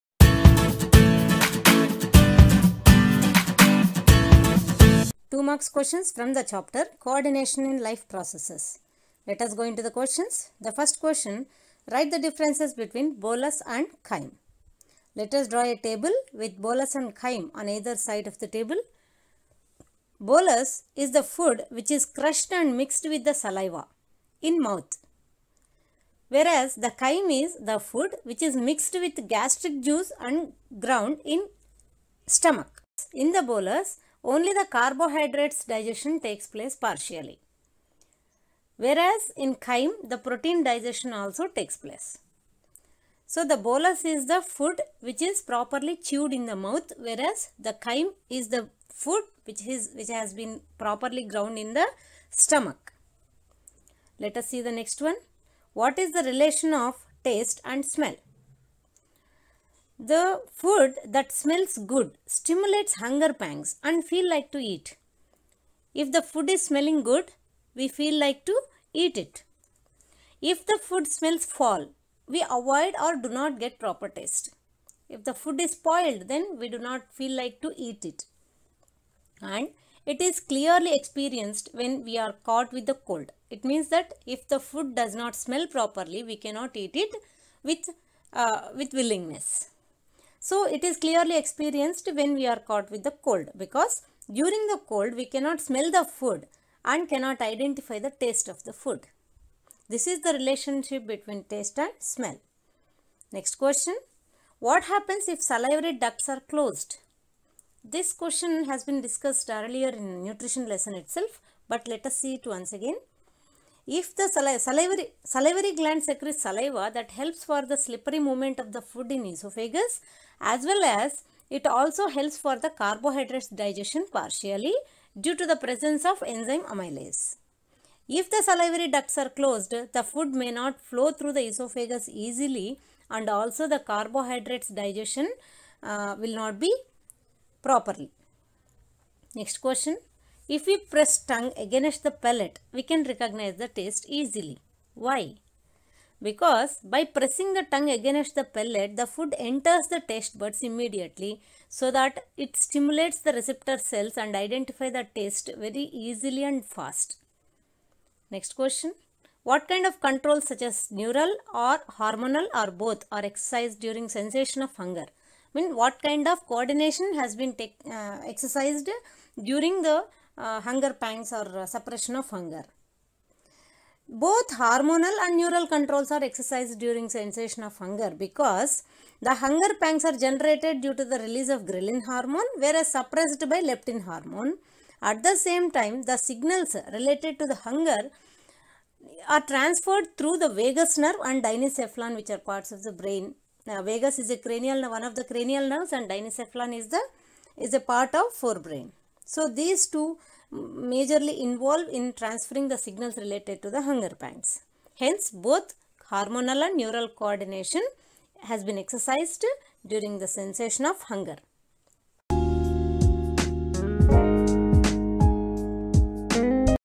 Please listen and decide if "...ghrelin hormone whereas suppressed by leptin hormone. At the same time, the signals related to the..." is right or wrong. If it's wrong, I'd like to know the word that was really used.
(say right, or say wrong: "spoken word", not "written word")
right.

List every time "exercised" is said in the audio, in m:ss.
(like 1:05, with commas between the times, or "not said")
2:43, 2:48, 2:56, 3:28.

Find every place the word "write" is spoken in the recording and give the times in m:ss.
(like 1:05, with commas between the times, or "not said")
0:11.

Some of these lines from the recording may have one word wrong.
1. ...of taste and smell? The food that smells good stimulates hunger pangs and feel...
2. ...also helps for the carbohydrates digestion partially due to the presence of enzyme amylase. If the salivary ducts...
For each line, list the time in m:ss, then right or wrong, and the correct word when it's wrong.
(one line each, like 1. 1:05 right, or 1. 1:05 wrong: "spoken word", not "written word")
1. 0:56 right
2. 2:01 right.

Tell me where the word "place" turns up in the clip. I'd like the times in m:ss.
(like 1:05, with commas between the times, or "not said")
0:36, 0:41.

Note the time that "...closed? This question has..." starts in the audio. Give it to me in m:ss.
1:46.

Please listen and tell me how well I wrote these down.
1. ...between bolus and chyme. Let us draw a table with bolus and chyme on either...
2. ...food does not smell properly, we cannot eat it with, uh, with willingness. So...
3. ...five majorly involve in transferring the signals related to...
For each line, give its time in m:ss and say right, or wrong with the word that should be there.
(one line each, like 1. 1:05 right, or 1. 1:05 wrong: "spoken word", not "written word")
1. 0:12 right
2. 1:24 right
3. 3:19 wrong: "two", not "five".